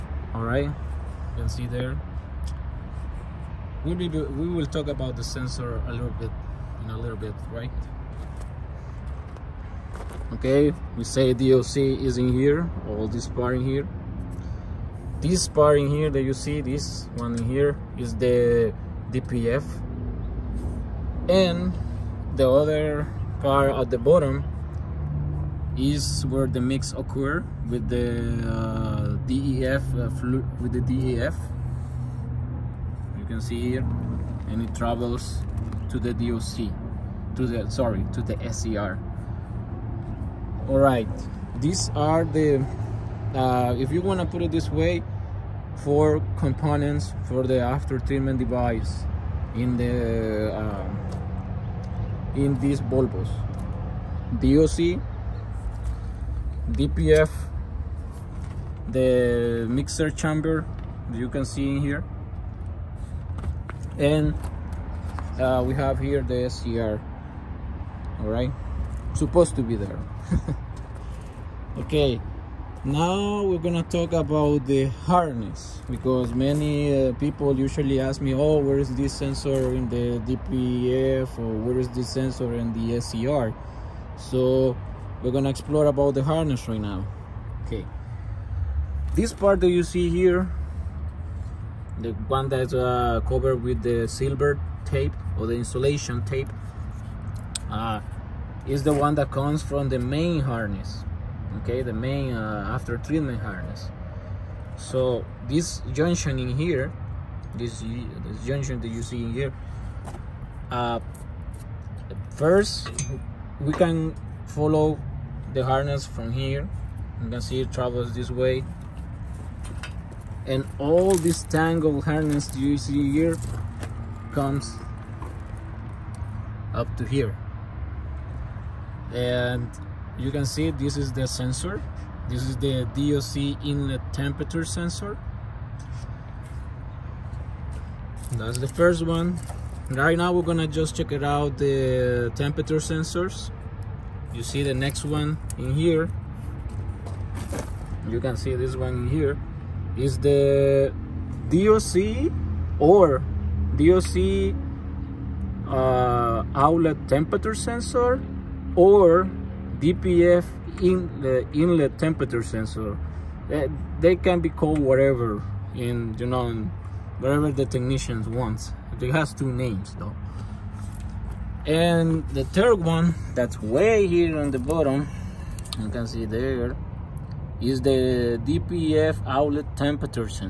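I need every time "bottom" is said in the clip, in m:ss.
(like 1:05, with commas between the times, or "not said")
0:23, 2:54.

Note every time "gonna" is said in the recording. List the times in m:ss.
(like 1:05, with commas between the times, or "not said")
1:13, 1:25, 2:20.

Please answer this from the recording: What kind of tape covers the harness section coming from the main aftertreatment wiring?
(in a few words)
silver tape.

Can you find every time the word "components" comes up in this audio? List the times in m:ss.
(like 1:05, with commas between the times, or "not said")
0:46.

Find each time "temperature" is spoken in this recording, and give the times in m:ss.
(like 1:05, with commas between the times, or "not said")
2:14, 2:22, 2:37, 2:41, 2:59.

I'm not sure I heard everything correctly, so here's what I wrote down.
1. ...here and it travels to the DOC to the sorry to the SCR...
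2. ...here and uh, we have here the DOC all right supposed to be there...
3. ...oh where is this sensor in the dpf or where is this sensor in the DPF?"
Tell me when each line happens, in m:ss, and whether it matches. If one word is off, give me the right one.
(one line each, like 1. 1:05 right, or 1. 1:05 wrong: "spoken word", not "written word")
1. 0:33 right
2. 1:01 wrong: "SCR", not "DOC"
3. 1:18 wrong: "SCR", not "DPF".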